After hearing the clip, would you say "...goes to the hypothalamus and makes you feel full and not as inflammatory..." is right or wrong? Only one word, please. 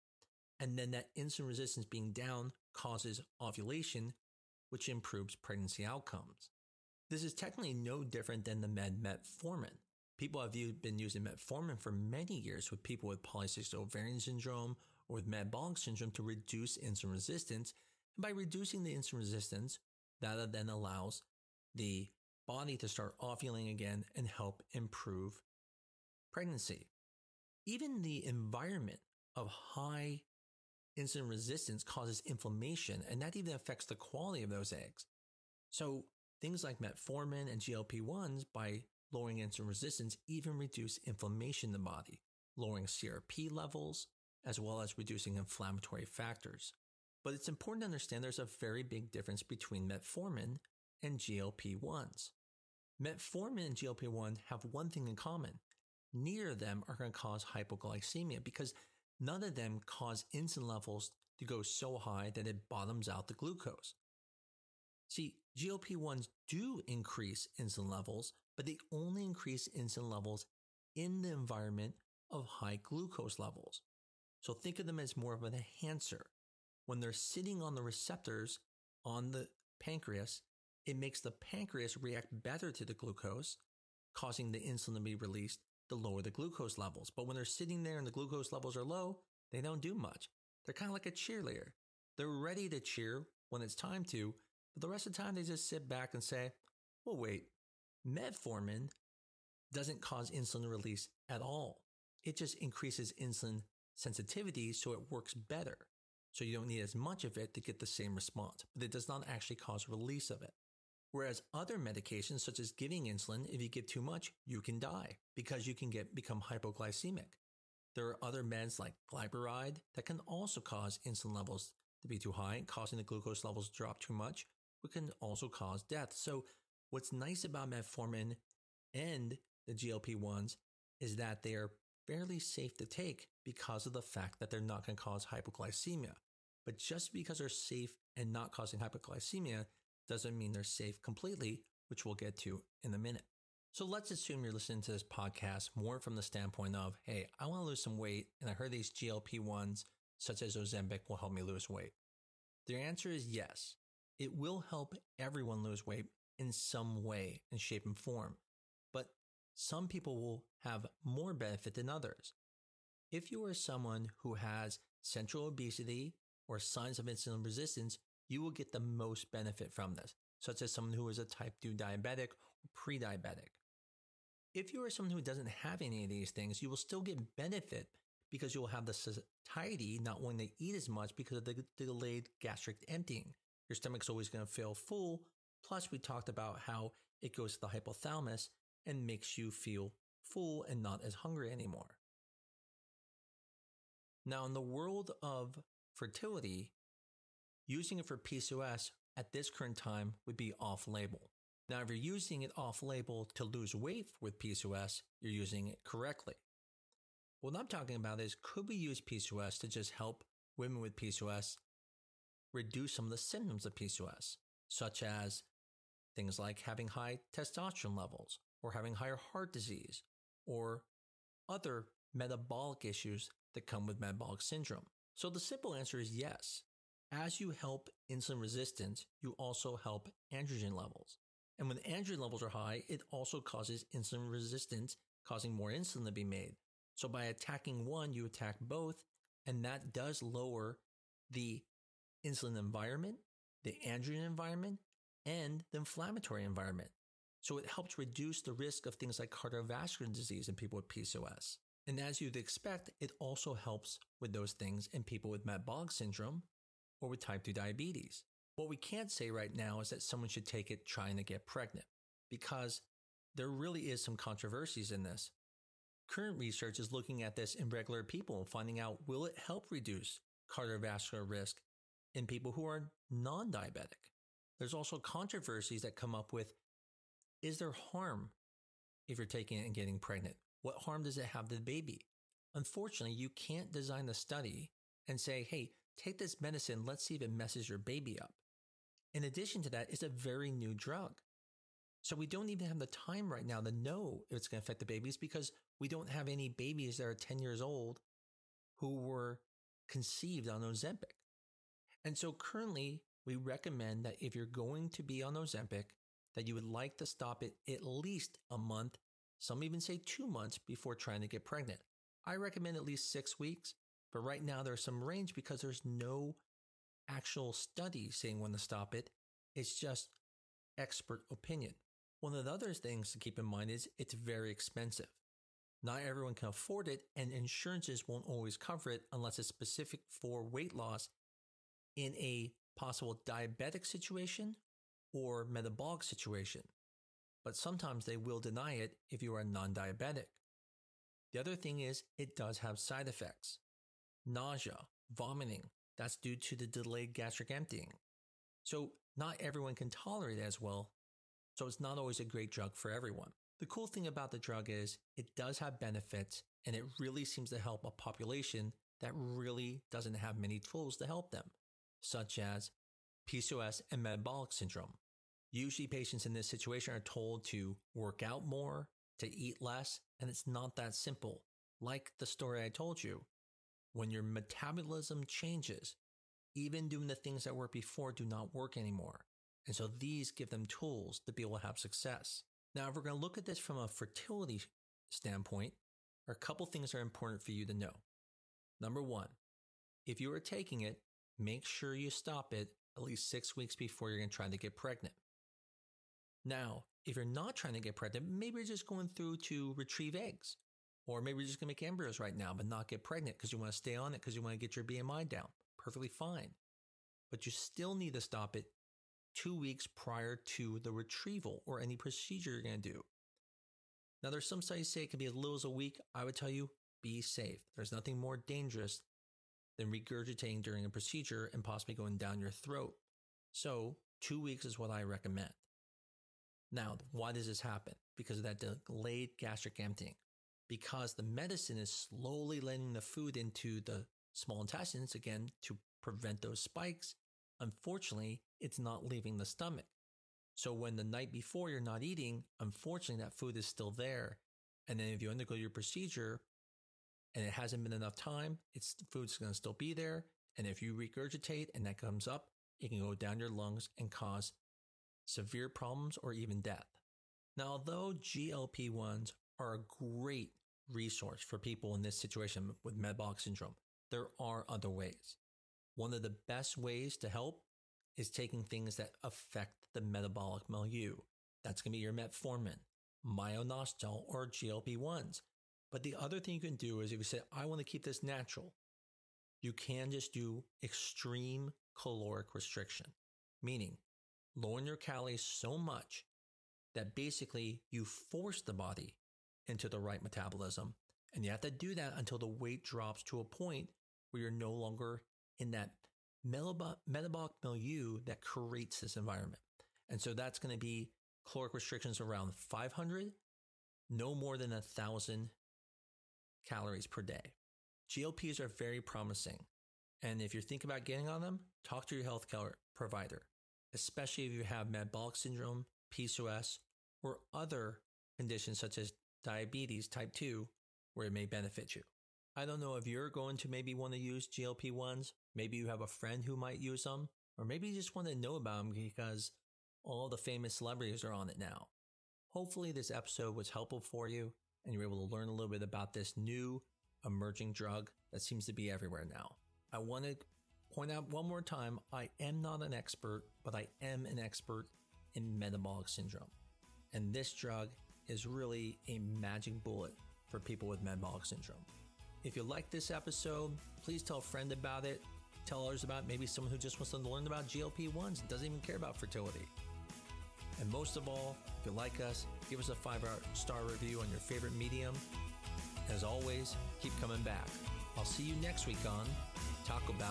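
wrong.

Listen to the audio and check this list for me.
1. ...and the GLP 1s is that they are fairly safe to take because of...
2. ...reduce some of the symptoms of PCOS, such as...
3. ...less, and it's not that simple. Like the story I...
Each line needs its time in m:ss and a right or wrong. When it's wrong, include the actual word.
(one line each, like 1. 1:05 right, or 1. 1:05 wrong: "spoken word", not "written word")
1. 2:08 right
2. 3:32 right
3. 6:09 right.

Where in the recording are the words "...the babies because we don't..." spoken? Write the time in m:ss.
4:54.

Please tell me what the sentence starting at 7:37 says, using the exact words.
Now, although GLP 1s are a great resource for people in this situation with metabolic syndrome.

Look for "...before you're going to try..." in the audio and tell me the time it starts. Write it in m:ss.
6:33.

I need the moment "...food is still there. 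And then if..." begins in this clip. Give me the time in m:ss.
7:23.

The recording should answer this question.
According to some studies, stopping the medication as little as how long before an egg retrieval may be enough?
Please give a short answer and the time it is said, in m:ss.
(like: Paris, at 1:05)
1 week, at 6:55.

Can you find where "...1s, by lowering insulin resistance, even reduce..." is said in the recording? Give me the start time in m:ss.
0:38.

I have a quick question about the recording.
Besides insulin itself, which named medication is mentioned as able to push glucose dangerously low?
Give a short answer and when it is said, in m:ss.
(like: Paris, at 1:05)
Glyburide, at 1:59.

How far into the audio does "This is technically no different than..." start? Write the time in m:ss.
0:07.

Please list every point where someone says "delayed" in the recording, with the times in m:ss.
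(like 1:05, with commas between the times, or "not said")
3:01, 5:46, 7:08.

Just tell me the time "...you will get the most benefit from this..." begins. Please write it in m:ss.
2:48.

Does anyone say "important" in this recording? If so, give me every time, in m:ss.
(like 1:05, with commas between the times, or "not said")
0:47, 6:26.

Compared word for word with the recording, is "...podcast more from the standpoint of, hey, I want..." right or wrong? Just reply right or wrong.
right.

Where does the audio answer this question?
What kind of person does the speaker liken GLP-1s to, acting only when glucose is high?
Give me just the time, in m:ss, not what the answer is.
1:31.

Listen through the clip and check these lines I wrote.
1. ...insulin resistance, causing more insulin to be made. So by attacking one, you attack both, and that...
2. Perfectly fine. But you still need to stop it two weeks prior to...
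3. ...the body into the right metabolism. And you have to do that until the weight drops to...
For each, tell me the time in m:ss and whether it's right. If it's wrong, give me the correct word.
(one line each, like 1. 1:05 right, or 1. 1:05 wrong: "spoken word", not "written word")
1. 3:53 right
2. 6:45 right
3. 8:08 right.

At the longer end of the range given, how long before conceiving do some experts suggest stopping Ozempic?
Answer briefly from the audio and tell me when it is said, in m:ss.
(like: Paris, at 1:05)
2 months, at 5:09.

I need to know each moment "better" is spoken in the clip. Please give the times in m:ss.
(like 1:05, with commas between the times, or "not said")
1:22, 1:45.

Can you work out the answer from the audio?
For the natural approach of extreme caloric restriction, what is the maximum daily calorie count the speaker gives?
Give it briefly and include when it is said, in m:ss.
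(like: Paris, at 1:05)
1,000 calories, at 8:24.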